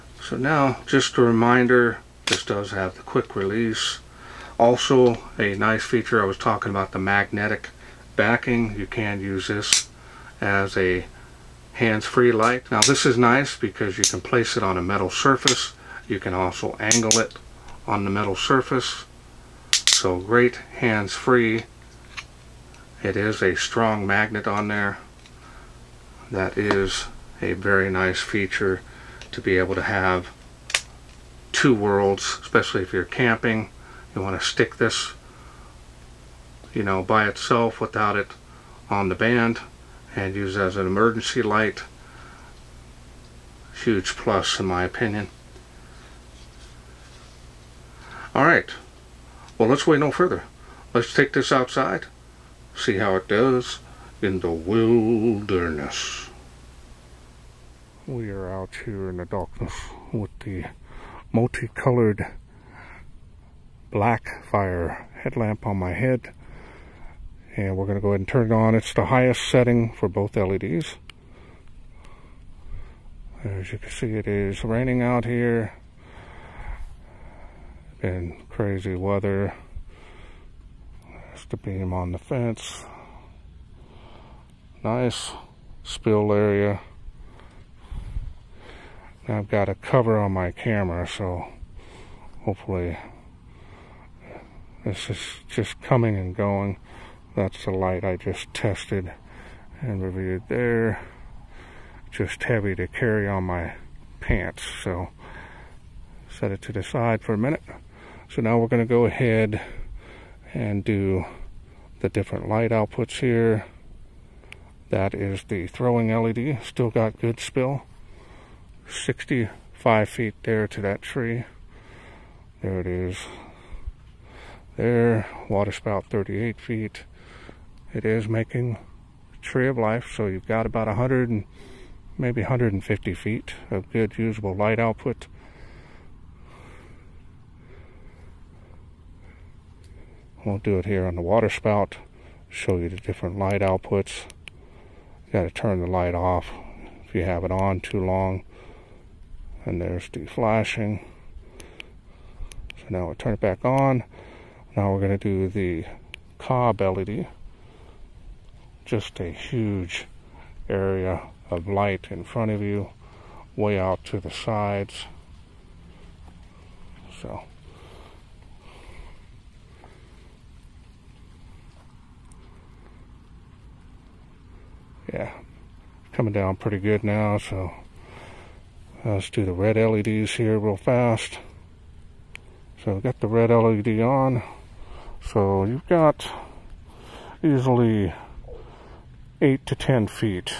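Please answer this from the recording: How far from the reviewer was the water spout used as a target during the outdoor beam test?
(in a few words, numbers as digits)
38 feet.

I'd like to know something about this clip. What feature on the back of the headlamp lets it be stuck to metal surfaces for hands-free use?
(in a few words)
magnetic backing.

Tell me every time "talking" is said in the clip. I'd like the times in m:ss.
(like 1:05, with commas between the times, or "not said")
0:06.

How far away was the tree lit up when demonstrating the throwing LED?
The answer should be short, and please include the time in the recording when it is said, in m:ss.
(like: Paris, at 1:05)
65 feet, at 1:58.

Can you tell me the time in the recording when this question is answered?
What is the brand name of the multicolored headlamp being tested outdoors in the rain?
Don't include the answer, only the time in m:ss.
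1:03.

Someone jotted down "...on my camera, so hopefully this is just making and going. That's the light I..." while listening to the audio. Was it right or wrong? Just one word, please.
wrong.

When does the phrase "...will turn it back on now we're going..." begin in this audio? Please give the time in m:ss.
2:33.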